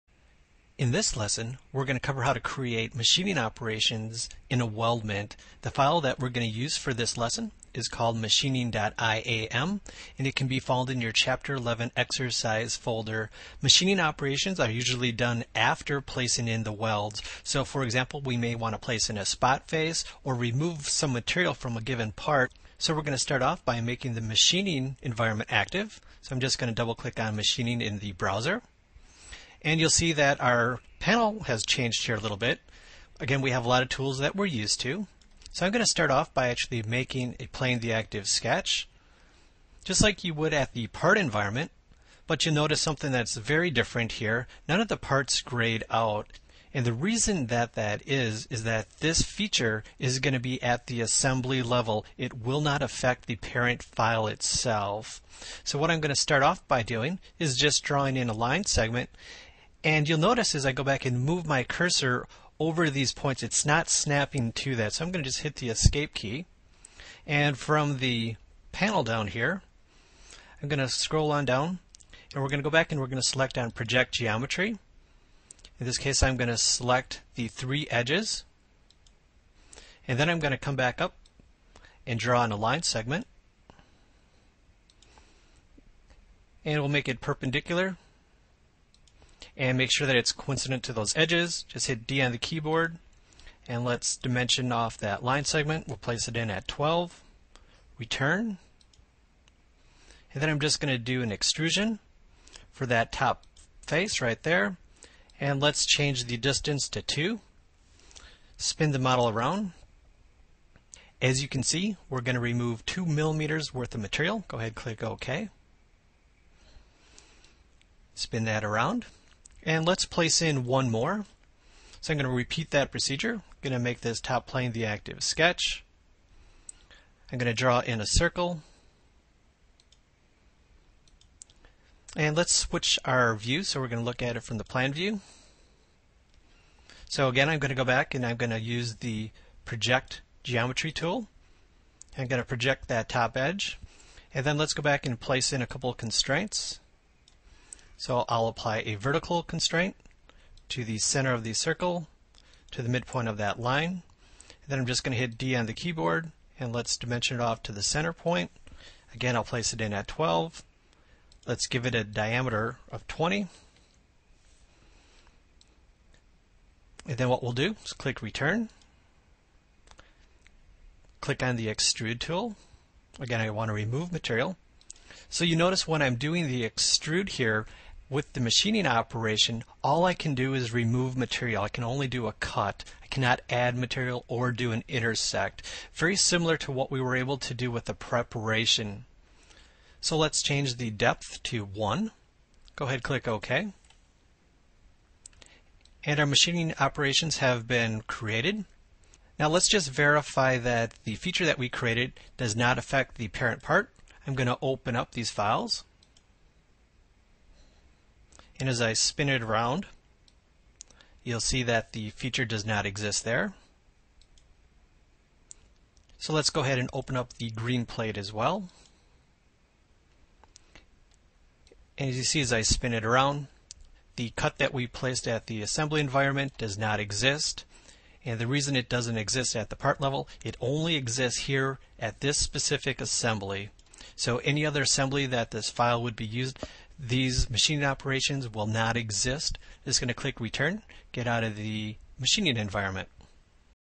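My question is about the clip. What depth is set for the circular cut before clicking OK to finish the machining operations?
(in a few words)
1.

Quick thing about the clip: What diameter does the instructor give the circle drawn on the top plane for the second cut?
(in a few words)
20.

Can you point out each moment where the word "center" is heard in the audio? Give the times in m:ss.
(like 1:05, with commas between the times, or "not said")
2:30, 2:37.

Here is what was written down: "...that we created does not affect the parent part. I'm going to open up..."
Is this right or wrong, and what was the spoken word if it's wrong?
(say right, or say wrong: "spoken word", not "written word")
right.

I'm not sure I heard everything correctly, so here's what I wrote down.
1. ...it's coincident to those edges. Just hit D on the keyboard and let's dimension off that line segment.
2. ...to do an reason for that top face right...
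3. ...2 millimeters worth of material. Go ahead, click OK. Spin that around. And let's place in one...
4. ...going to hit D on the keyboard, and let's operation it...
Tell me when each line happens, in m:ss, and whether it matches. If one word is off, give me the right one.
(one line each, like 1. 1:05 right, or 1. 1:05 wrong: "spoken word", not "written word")
1. 1:30 right
2. 1:40 wrong: "extrusion", not "reason"
3. 1:52 right
4. 2:35 wrong: "dimension", not "operation".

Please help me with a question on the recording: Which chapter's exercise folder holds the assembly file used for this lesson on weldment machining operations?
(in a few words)
Chapter 11.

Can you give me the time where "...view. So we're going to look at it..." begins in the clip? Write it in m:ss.
2:13.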